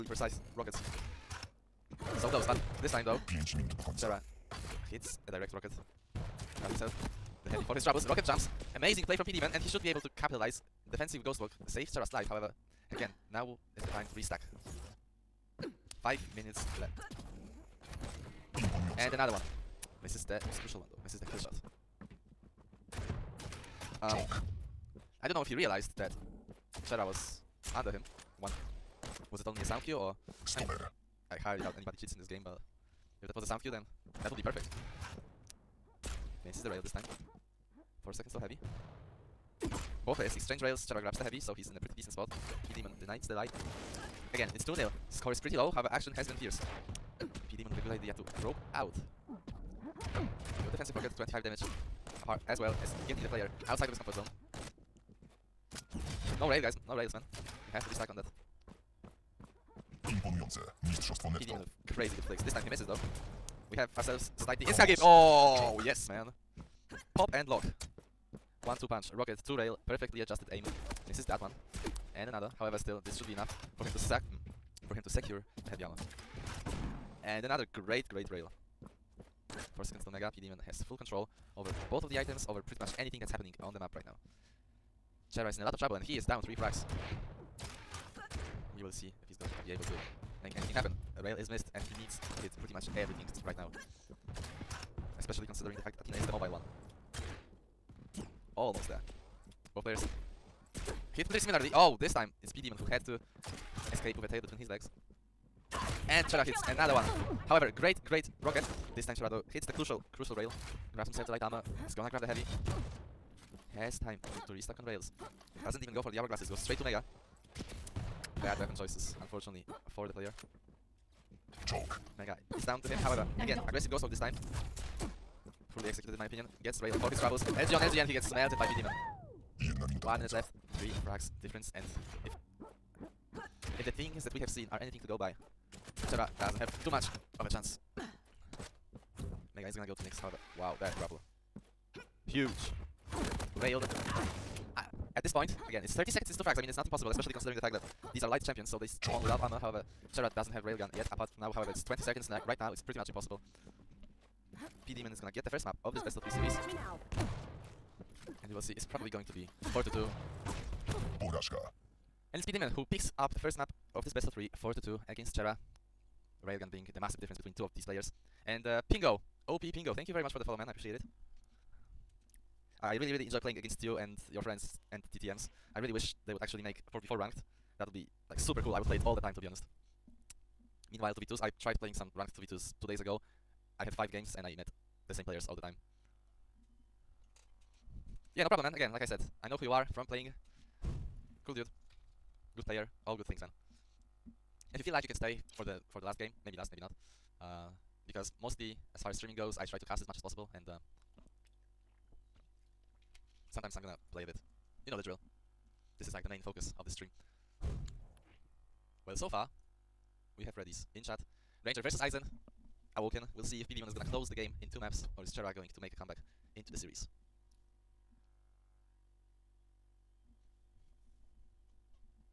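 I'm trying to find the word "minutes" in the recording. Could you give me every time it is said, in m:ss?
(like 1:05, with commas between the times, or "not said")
0:16, 2:10.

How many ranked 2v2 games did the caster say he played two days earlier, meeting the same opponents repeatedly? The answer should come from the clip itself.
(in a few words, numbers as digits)
5.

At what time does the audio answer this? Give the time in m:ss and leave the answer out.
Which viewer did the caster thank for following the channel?
2:49.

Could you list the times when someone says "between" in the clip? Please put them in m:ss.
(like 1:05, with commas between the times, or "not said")
1:44, 2:47.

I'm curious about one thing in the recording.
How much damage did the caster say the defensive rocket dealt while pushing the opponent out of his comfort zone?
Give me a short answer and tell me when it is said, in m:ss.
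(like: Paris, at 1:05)
25, at 0:51.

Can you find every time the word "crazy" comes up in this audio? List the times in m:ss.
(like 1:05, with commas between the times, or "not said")
1:01.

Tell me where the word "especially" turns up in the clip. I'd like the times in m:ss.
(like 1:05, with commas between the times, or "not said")
1:35, 2:27.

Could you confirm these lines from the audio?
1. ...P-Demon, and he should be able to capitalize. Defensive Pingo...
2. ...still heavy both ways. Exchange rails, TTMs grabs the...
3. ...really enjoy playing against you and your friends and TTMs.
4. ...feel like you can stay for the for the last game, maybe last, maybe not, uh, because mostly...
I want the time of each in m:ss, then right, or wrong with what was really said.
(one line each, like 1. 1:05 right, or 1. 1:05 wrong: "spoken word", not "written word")
1. 0:09 wrong: "Ghost", not "Pingo"
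2. 0:38 wrong: "Chera", not "TTMs"
3. 2:53 right
4. 3:14 right.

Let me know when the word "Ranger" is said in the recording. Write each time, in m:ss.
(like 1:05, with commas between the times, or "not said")
3:31.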